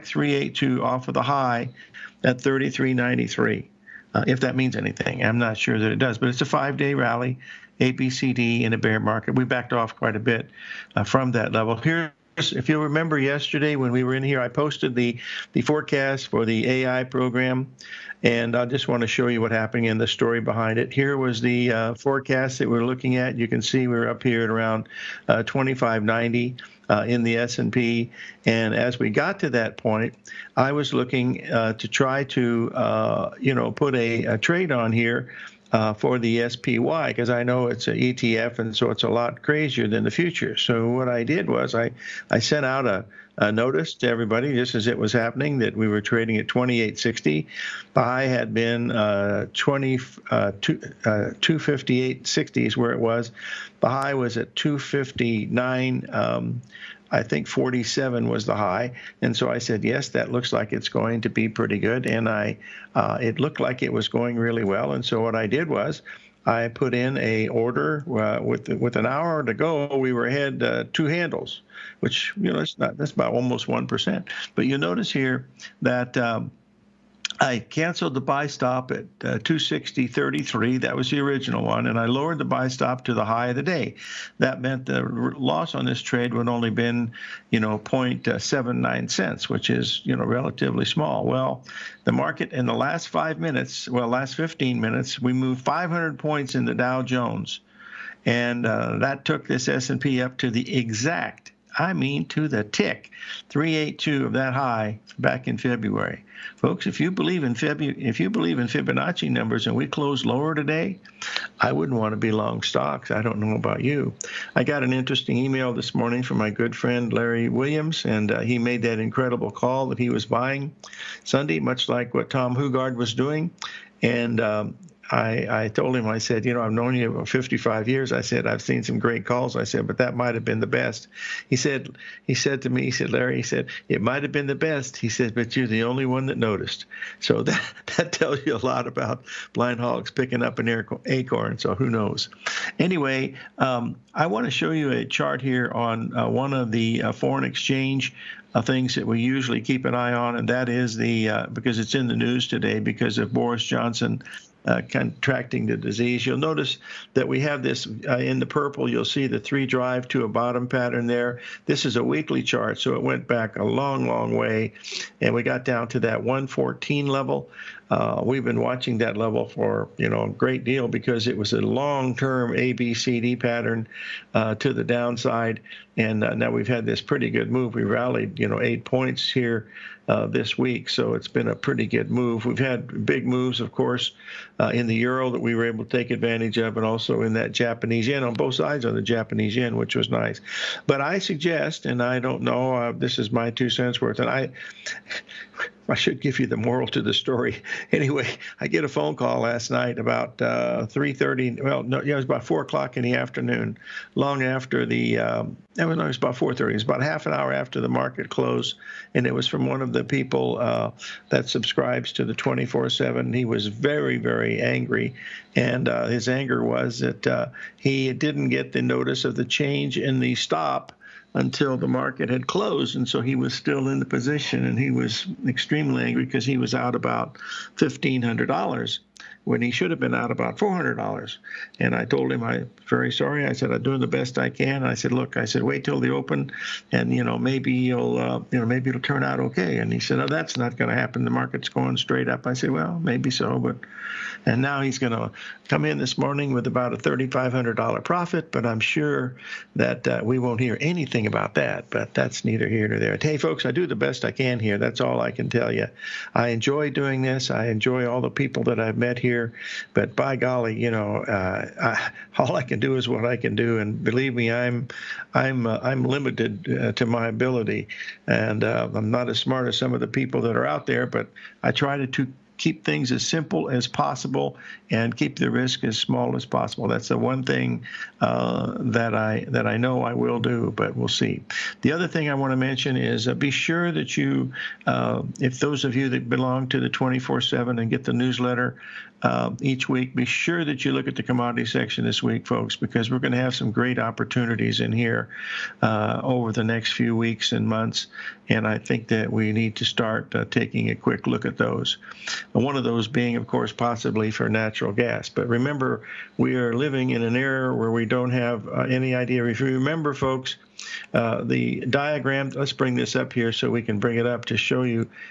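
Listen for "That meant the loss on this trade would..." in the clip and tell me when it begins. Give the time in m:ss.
1:24.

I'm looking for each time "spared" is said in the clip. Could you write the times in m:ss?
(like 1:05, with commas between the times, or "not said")
not said.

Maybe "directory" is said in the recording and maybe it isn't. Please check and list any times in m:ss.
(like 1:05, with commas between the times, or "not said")
not said.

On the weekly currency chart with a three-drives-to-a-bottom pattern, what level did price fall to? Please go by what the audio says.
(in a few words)
114.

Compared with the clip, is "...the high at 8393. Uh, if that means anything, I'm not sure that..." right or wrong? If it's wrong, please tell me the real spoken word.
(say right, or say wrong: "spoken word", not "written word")
wrong: "3393", not "8393".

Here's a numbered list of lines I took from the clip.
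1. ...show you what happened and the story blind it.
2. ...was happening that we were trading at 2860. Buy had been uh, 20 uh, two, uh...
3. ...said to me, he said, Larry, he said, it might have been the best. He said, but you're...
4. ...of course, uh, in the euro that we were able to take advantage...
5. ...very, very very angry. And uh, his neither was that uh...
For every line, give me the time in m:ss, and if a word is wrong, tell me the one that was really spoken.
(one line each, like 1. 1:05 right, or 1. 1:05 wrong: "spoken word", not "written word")
1. 0:19 wrong: "behind", not "blind"
2. 0:44 right
3. 2:12 right
4. 3:03 right
5. 3:33 wrong: "anger", not "neither".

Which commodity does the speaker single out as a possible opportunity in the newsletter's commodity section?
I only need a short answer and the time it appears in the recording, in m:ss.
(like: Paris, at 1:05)
natural gas, at 5:04.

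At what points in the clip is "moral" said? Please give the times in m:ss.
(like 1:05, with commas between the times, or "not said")
3:16.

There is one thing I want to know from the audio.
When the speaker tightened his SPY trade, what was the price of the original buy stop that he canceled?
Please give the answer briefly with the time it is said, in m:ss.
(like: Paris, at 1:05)
260.33, at 1:19.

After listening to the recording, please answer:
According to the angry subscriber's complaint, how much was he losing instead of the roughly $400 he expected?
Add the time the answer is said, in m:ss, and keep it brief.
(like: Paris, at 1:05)
$1,500, at 3:47.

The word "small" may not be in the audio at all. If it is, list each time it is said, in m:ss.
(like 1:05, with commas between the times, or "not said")
1:30, 4:35.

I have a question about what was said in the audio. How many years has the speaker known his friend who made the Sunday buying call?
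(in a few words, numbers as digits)
55.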